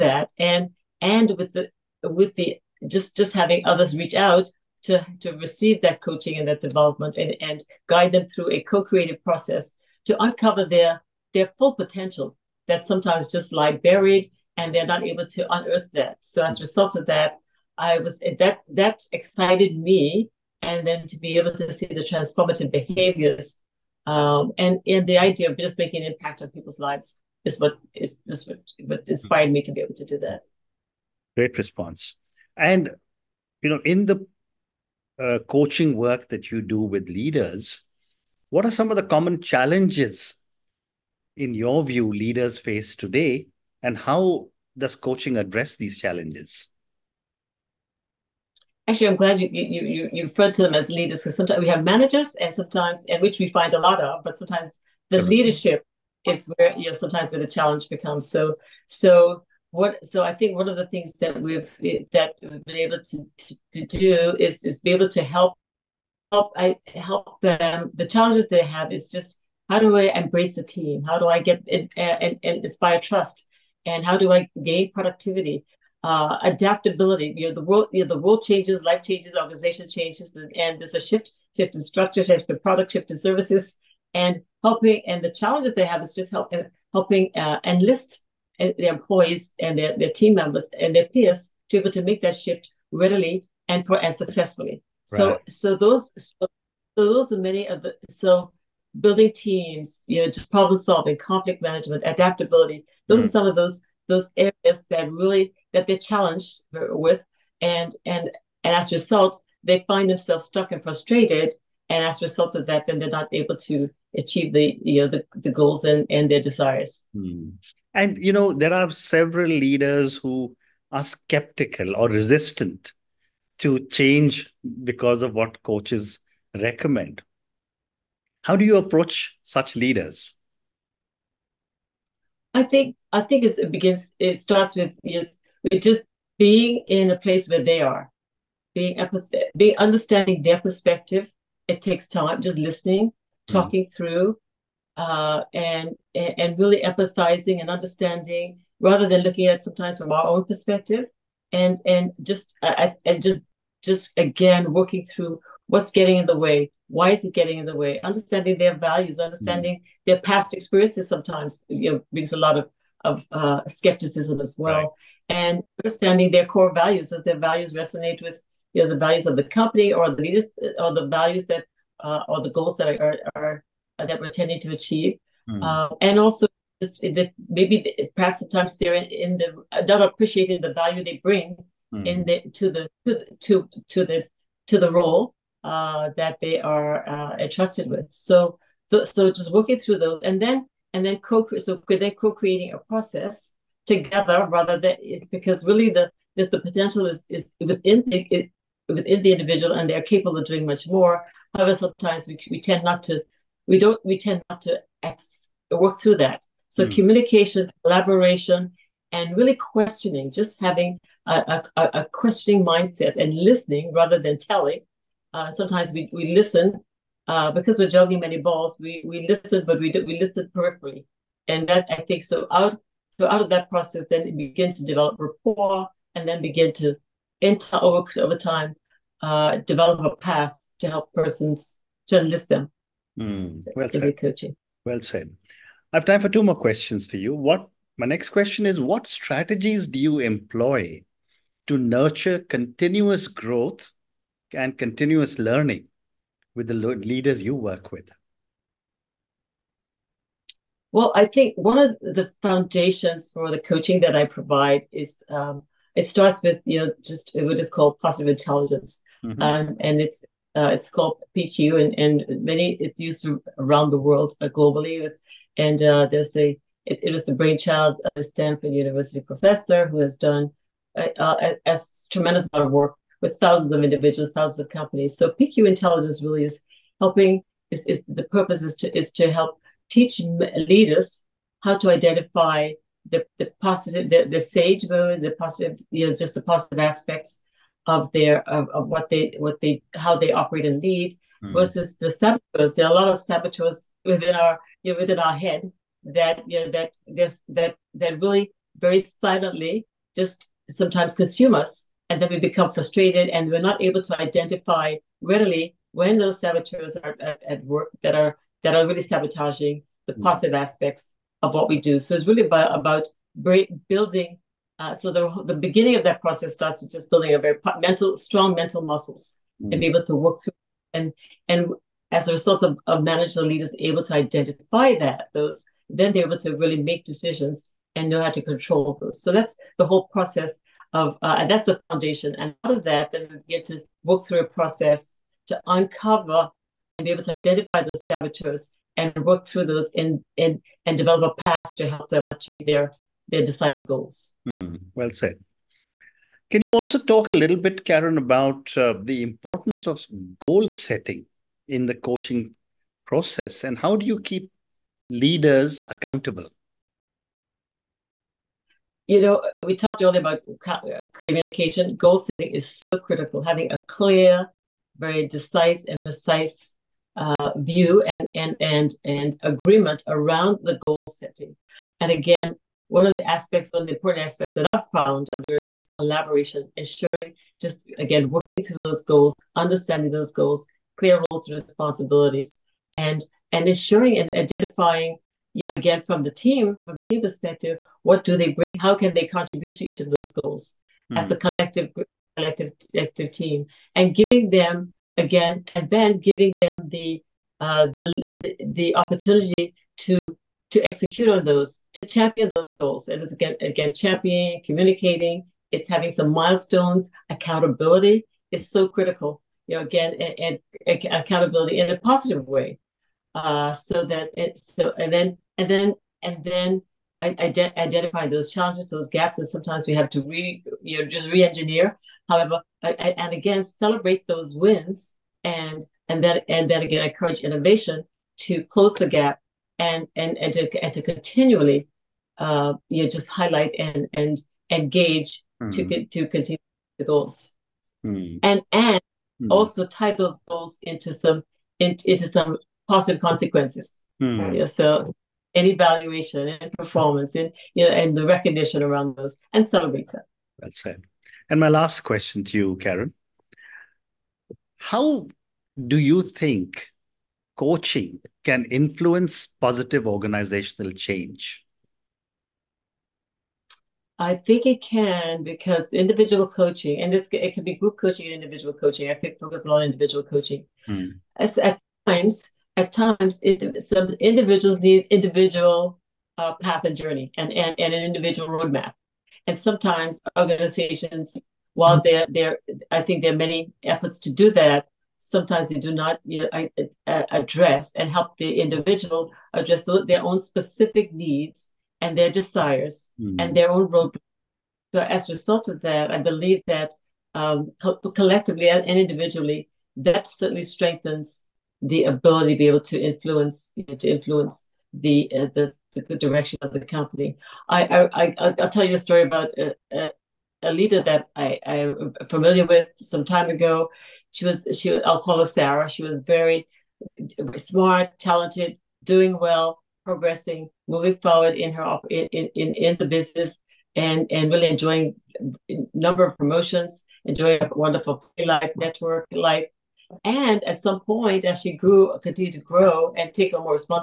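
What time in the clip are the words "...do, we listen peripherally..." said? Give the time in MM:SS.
03:39.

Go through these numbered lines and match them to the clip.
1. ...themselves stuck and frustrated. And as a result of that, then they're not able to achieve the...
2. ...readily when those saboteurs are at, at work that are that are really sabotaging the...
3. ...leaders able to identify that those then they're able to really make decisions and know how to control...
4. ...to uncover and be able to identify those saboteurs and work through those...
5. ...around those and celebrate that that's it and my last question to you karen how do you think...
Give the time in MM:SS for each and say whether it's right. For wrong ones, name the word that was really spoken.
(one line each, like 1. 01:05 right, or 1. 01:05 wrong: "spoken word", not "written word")
1. 01:50 right
2. 05:05 right
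3. 05:23 right
4. 05:35 right
5. 07:28 right.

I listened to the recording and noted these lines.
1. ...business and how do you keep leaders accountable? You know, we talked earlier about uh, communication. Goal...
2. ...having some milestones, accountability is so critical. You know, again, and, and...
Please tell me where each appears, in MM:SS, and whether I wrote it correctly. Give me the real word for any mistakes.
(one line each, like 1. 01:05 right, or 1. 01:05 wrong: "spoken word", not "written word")
1. 05:53 wrong: "process", not "business"
2. 06:45 right.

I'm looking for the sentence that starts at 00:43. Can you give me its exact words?
And how does coaching address these challenges?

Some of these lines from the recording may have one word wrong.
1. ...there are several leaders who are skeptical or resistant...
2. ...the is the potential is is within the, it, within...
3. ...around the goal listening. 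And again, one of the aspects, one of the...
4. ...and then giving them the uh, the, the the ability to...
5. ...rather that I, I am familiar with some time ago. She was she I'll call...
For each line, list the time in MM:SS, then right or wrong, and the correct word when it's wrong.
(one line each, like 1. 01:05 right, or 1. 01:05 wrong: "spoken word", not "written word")
1. 01:58 right
2. 03:15 right
3. 06:10 wrong: "setting", not "listening"
4. 06:35 wrong: "opportunity", not "ability"
5. 08:30 wrong: "leader", not "rather".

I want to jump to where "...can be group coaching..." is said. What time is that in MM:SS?
07:47.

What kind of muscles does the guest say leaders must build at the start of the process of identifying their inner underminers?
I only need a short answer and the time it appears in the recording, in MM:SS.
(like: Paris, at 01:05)
strong mental muscles, at 05:18.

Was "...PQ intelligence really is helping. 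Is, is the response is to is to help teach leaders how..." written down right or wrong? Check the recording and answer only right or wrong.
wrong.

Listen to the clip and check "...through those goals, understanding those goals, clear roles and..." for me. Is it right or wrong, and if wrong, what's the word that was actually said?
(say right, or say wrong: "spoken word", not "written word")
right.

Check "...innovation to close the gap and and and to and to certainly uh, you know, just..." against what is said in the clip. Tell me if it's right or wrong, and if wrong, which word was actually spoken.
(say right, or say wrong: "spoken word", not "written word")
wrong: "continually", not "certainly".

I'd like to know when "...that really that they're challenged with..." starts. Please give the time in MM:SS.
01:44.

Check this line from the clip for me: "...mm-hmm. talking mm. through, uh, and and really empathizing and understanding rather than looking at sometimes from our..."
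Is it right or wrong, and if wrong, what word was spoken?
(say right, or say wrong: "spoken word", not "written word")
right.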